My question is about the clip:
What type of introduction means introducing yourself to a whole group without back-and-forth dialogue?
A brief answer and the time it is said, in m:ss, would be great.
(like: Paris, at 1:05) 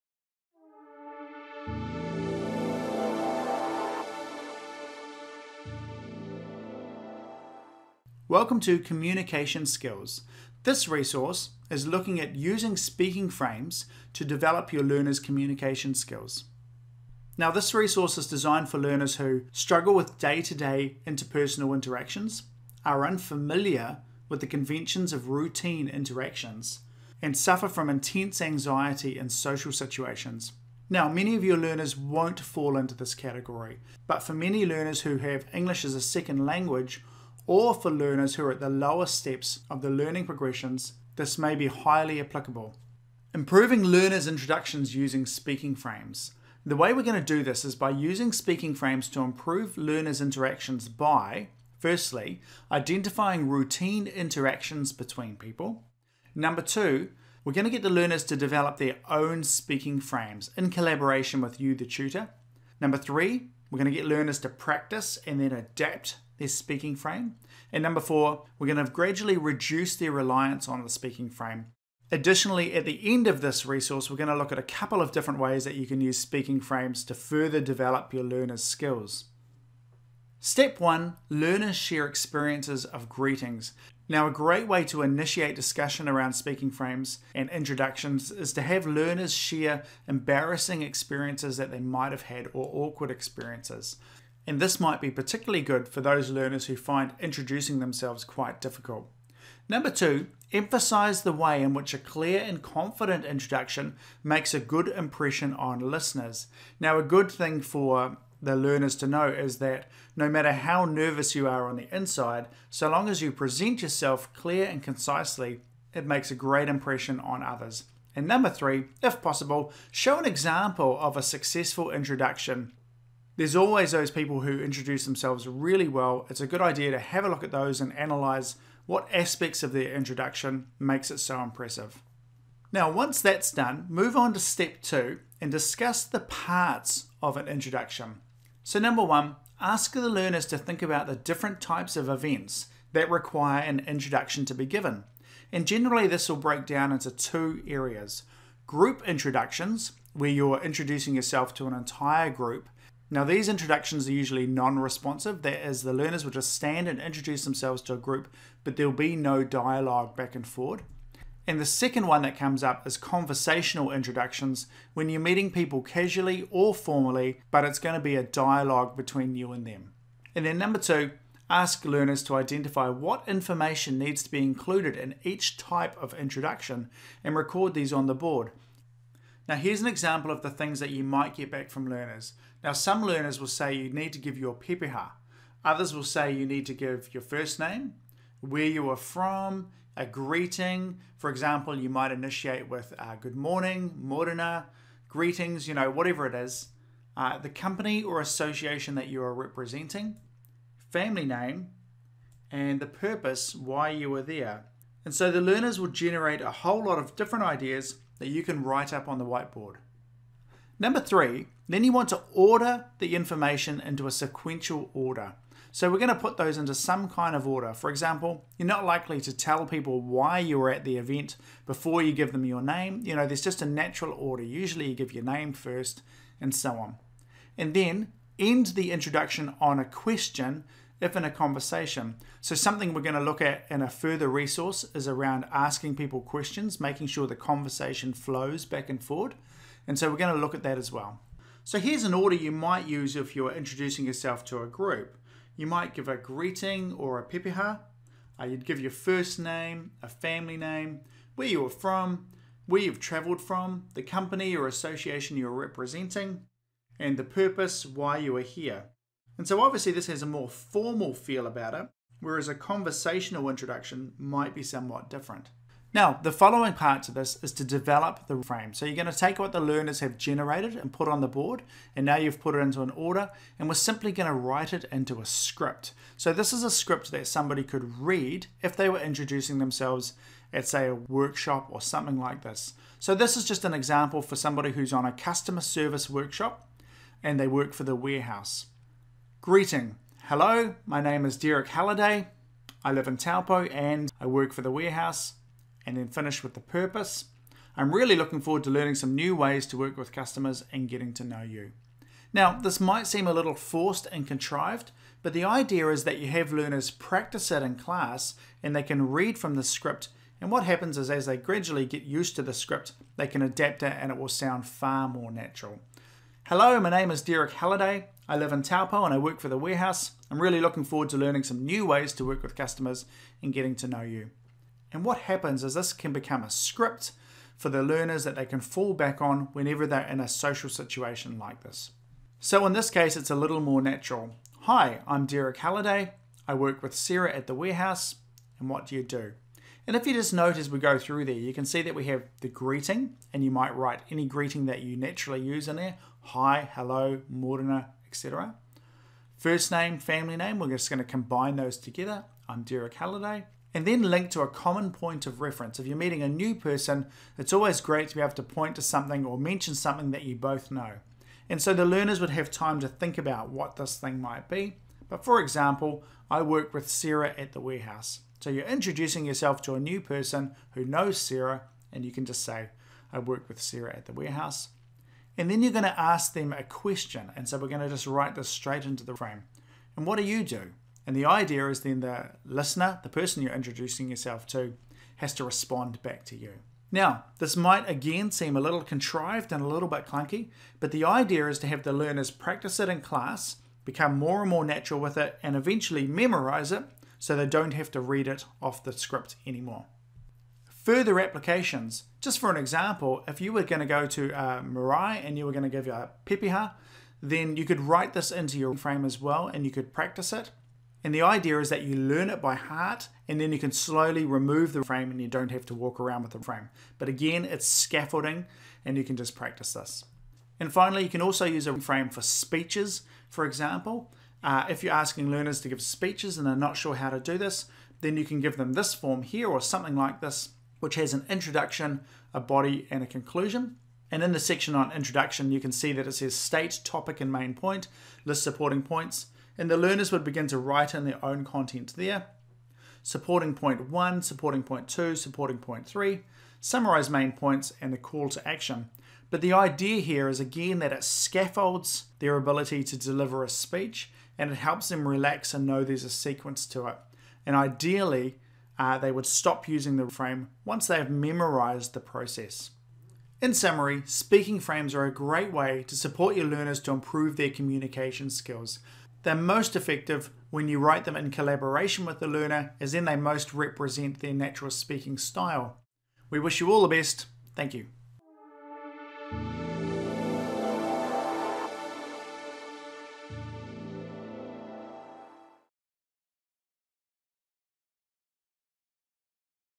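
group introductions, at 2:28.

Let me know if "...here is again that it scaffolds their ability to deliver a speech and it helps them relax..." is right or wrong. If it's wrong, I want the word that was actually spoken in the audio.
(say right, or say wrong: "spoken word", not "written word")
right.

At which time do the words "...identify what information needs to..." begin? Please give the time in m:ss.
2:52.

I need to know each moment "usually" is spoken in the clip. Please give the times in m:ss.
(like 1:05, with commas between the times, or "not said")
2:34, 3:44.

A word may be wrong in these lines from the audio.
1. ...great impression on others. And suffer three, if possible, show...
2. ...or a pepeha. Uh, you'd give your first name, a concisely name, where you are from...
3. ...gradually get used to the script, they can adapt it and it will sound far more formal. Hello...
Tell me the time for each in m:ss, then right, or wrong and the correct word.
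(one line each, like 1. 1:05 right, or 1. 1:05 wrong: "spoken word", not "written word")
1. 1:56 wrong: "number", not "suffer"
2. 4:06 wrong: "family", not "concisely"
3. 5:11 wrong: "natural", not "formal".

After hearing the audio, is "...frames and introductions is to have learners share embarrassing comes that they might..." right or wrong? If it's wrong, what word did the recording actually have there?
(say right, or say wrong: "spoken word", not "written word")
wrong: "experiences", not "comes".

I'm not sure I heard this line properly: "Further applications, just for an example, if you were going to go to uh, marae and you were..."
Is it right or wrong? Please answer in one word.
right.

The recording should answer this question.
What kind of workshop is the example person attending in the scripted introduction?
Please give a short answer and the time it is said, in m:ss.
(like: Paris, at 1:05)
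customer service, at 4:45.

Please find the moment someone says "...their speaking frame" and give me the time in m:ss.
1:06.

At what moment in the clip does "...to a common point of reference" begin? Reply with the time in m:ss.
5:54.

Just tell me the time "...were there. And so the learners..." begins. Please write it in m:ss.
3:24.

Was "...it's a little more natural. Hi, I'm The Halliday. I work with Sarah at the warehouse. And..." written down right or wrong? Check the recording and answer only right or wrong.
wrong.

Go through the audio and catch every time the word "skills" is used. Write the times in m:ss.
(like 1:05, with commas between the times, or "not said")
0:09, 0:15, 1:18, 7:48.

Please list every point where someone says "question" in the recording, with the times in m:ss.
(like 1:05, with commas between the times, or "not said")
3:49, 3:56, 6:16.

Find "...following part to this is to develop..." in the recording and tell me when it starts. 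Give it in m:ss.
4:26.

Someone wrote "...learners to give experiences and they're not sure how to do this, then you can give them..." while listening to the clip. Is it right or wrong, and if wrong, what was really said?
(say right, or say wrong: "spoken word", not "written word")
wrong: "speeches", not "experiences".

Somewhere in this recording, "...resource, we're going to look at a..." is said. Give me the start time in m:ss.
1:13.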